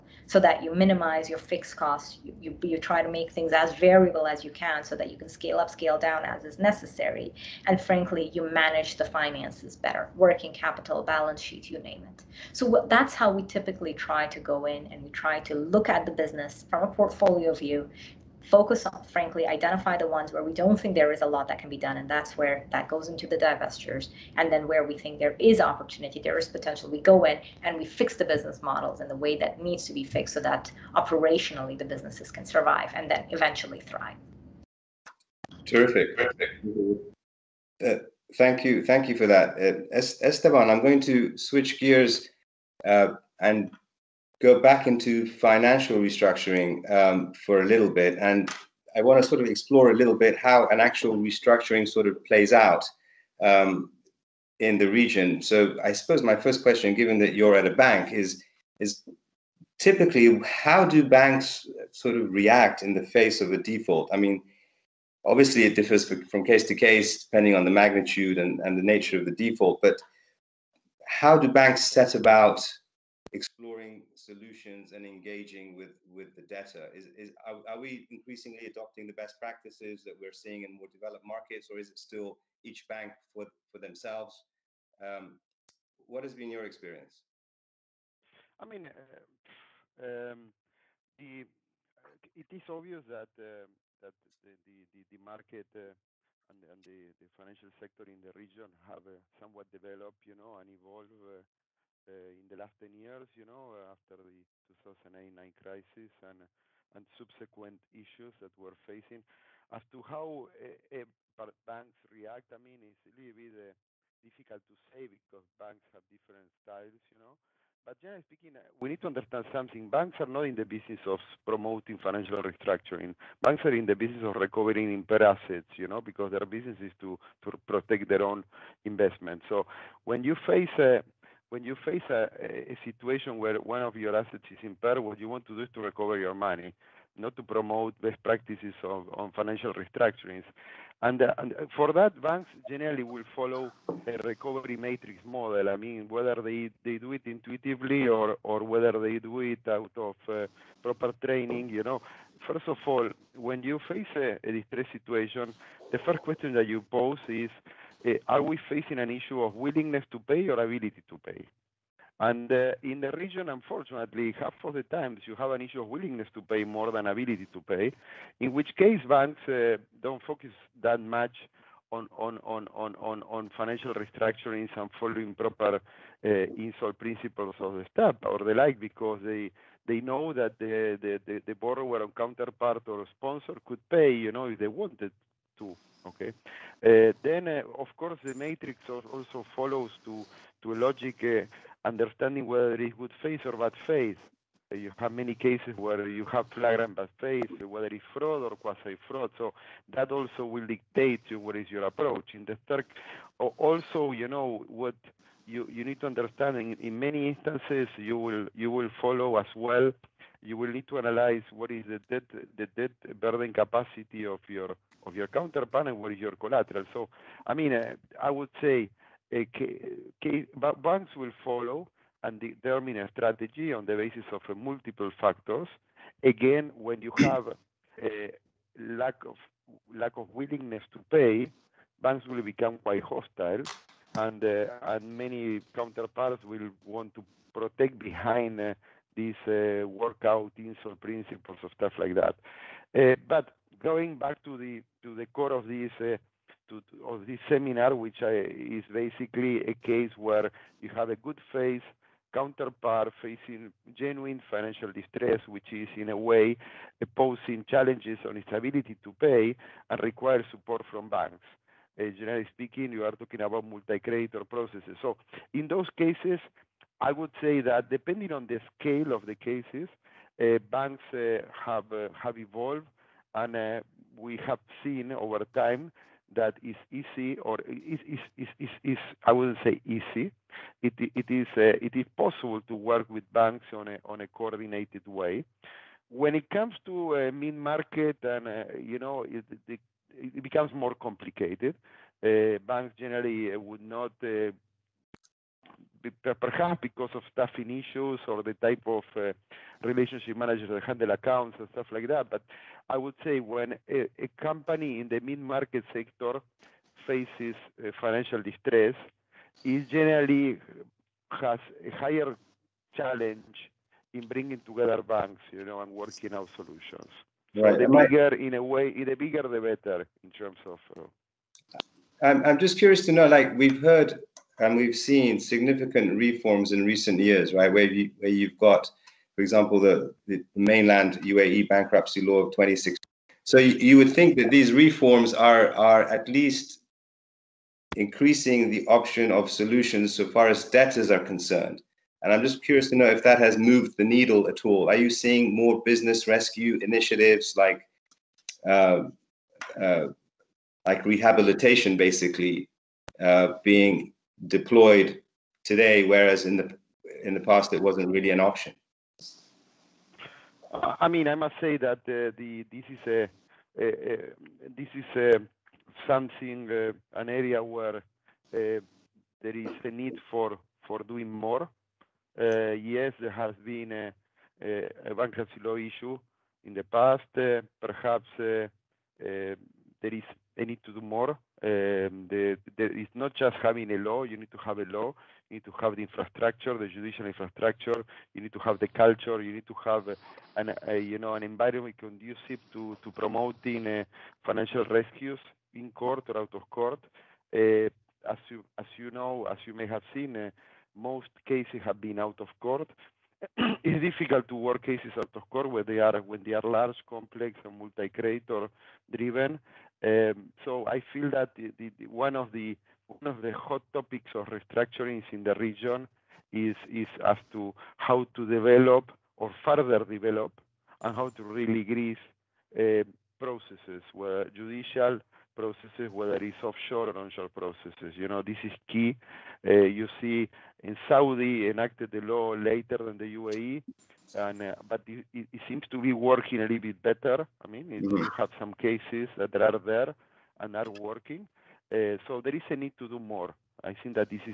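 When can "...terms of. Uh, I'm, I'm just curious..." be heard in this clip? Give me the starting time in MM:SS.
05:20.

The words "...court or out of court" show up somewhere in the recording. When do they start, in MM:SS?
06:35.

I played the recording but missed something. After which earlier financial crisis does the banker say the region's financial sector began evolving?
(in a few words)
2008-9 crisis.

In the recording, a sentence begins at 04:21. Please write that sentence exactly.
Uh, generally speaking, you are talking about multi-creditor processes.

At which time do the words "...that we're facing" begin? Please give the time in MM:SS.
01:48.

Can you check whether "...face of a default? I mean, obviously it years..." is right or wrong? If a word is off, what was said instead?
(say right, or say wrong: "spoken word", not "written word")
wrong: "differs", not "years".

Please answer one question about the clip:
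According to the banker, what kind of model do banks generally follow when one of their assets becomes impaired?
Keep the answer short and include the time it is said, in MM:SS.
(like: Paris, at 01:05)
Recovery matrix model, at 02:24.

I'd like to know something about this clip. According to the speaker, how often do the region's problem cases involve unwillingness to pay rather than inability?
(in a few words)
Half of the times.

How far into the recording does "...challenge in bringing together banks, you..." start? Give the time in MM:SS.
05:12.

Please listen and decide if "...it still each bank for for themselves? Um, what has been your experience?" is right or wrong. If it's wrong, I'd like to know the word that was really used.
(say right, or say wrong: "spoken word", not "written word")
right.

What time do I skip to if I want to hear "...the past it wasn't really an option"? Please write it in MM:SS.
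05:57.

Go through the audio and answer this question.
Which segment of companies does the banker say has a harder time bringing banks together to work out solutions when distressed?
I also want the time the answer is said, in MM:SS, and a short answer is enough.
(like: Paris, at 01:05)
Mid-market, at 05:05.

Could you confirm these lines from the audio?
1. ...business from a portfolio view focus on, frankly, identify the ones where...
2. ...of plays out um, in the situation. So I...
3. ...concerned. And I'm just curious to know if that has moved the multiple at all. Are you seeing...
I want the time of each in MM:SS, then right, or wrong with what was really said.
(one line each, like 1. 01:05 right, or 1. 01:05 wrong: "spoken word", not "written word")
1. 00:16 right
2. 00:52 wrong: "region", not "situation"
3. 05:41 wrong: "needle", not "multiple".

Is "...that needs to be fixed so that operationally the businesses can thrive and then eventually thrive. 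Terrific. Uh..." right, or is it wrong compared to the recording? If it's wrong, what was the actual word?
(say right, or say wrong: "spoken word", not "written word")
wrong: "survive", not "thrive".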